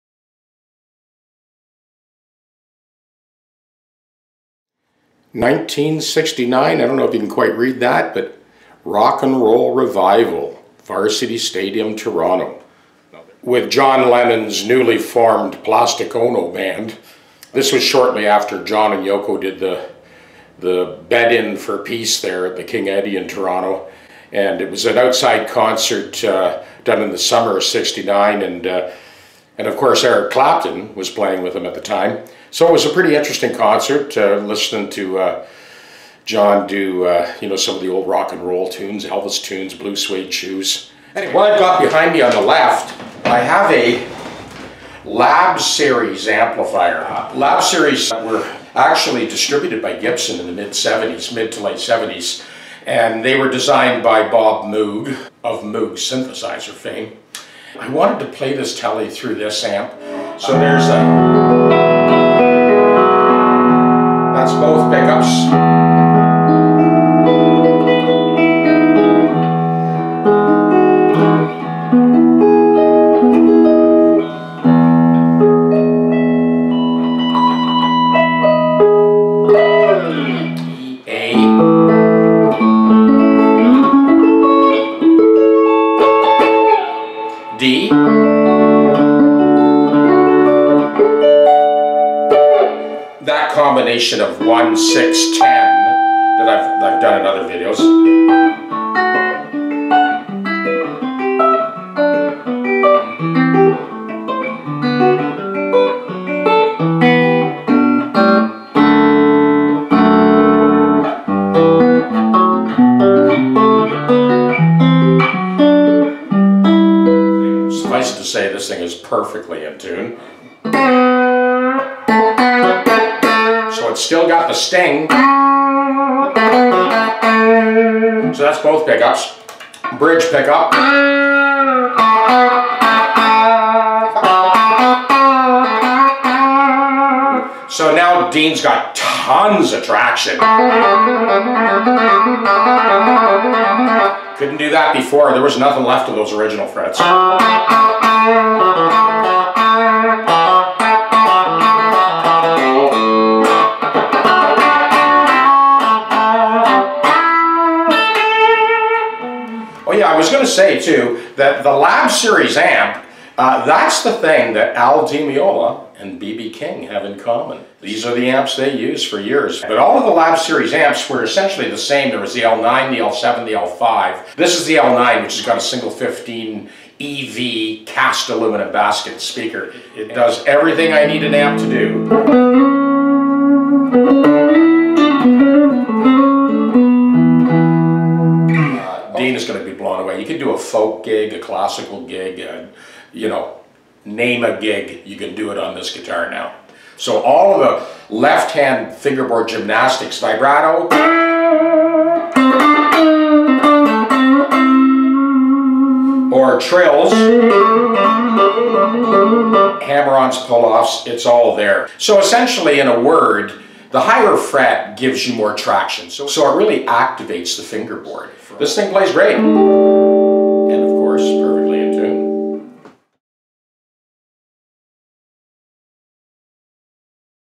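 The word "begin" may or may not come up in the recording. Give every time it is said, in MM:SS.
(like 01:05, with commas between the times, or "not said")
not said.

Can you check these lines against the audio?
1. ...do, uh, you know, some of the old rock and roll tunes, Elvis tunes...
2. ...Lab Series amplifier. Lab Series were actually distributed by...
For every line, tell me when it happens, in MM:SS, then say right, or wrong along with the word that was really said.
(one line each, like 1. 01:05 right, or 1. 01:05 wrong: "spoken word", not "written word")
1. 00:36 right
2. 00:45 right.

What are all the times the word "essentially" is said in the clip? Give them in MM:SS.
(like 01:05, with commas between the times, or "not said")
02:51, 03:32.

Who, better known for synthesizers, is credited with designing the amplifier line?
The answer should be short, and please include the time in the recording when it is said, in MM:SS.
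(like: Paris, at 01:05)
Bob Moog, at 00:54.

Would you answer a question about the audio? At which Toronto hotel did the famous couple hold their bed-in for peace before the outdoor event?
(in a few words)
King Eddie.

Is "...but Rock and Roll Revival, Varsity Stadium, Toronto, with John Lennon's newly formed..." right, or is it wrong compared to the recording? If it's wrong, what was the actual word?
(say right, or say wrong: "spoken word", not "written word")
right.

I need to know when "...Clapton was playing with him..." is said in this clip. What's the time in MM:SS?
00:30.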